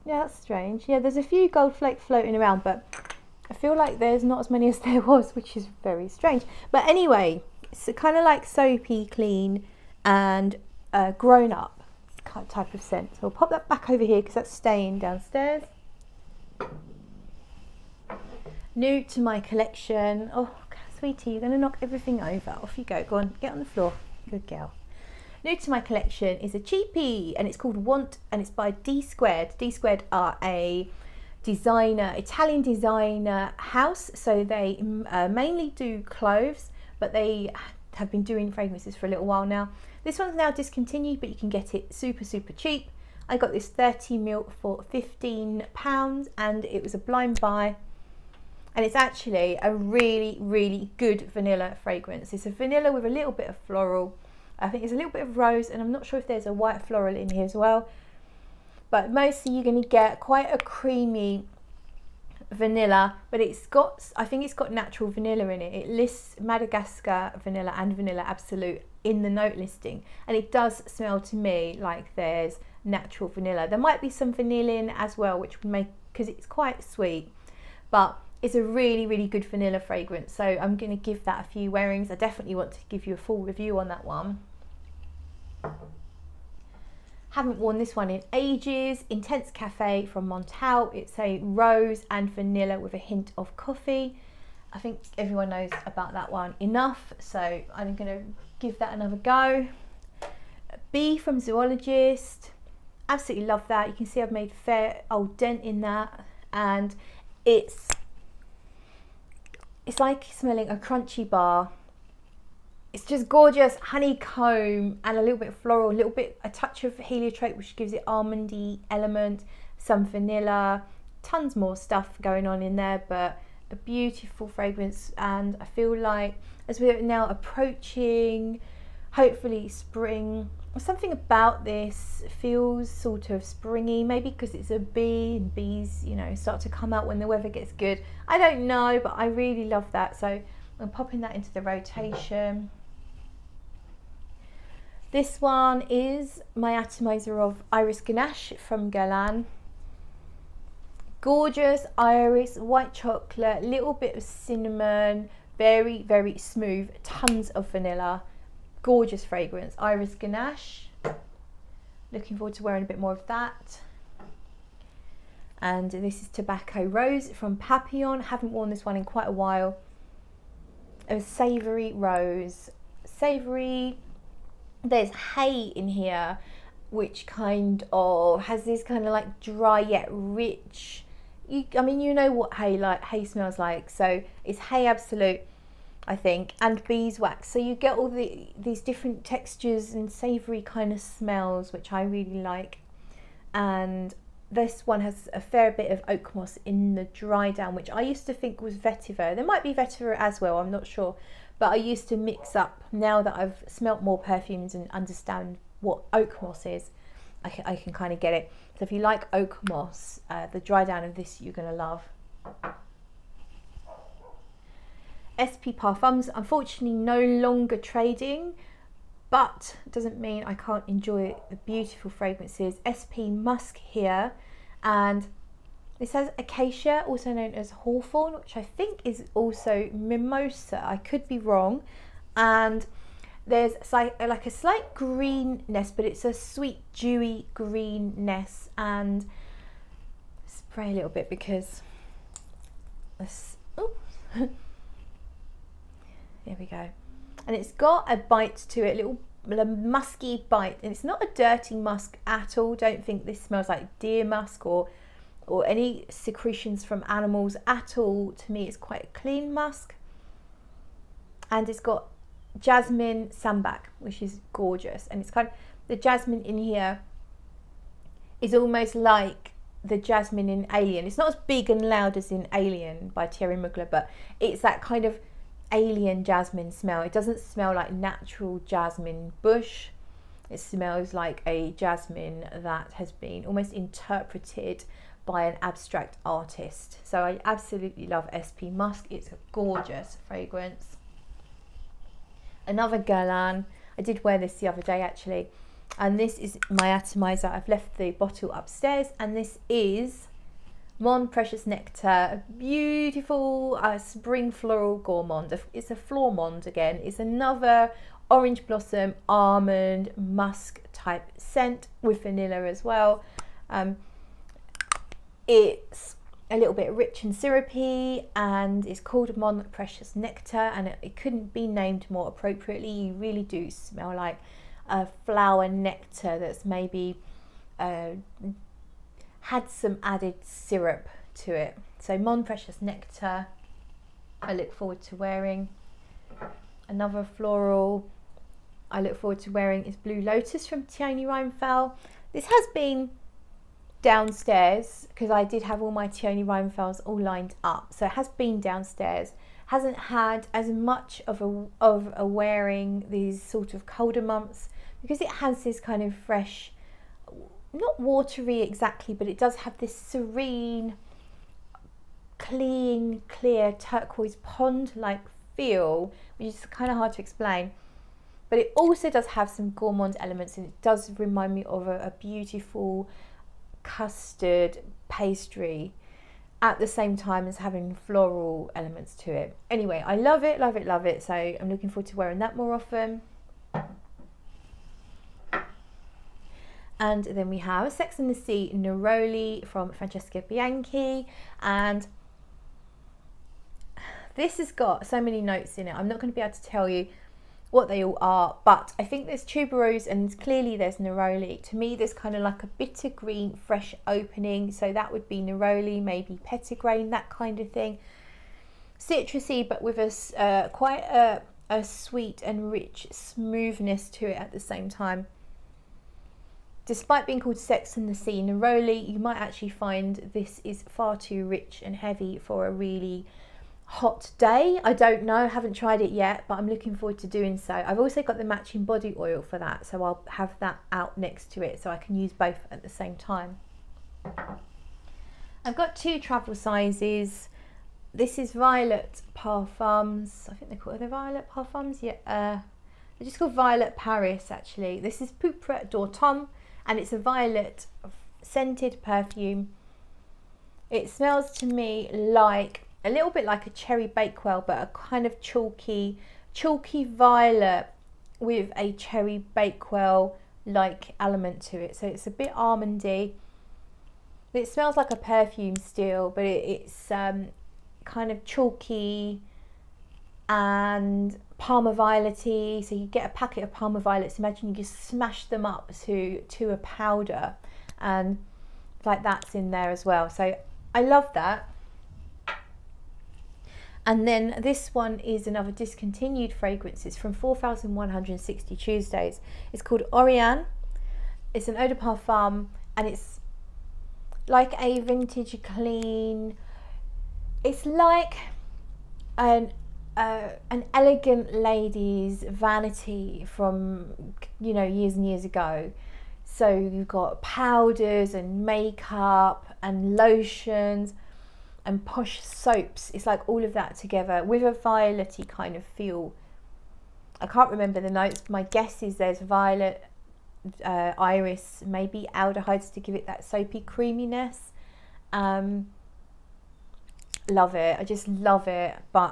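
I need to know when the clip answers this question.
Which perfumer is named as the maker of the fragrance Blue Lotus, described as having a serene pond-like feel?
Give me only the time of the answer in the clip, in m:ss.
5:40.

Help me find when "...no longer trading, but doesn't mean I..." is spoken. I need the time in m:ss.
3:36.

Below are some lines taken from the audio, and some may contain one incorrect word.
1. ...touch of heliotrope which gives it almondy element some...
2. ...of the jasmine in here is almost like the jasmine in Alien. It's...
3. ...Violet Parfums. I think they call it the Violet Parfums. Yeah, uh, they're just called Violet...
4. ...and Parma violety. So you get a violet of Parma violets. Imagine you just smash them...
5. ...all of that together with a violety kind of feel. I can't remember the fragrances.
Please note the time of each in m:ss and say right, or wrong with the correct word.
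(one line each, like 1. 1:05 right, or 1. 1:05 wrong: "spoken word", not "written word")
1. 1:56 right
2. 4:25 right
3. 7:18 right
4. 7:50 wrong: "packet", not "violet"
5. 8:33 wrong: "notes", not "fragrances".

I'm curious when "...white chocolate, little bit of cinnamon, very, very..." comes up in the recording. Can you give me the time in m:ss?
2:32.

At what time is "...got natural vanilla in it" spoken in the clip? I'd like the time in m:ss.
1:04.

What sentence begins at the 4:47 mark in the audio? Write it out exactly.
So I absolutely love SP Musk.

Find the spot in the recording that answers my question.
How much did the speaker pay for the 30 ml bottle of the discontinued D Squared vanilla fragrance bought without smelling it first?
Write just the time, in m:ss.
0:44.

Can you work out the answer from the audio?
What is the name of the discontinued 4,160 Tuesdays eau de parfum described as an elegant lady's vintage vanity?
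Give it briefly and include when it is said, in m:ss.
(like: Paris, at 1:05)
Oriane, at 8:10.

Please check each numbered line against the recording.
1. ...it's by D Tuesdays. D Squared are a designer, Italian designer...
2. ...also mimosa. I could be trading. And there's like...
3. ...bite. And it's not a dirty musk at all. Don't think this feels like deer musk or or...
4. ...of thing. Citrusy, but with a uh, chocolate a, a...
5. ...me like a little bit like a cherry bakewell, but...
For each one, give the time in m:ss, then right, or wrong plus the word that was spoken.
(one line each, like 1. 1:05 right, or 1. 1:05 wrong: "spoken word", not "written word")
1. 0:28 wrong: "Squared", not "Tuesdays"
2. 3:49 wrong: "wrong", not "trading"
3. 4:10 wrong: "smells", not "feels"
4. 6:47 wrong: "quite", not "chocolate"
5. 7:31 right.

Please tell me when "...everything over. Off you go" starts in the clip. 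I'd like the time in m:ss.
0:21.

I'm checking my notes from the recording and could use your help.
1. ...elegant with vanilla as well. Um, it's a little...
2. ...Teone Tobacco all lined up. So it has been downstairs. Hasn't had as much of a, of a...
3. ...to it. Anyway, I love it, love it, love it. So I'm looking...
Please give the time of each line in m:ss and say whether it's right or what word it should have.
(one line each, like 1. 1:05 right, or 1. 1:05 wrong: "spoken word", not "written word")
1. 5:11 wrong: "scent", not "elegant"
2. 5:46 wrong: "Reinthals", not "Tobacco"
3. 6:19 right.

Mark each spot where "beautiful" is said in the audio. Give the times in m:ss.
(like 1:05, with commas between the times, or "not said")
2:03, 3:41, 5:02, 6:12.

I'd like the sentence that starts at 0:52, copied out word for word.
It's a vanilla with a little bit of floral.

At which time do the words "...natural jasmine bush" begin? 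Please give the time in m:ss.
4:37.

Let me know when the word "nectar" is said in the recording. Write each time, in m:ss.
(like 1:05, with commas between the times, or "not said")
5:01, 5:20, 5:25, 5:32.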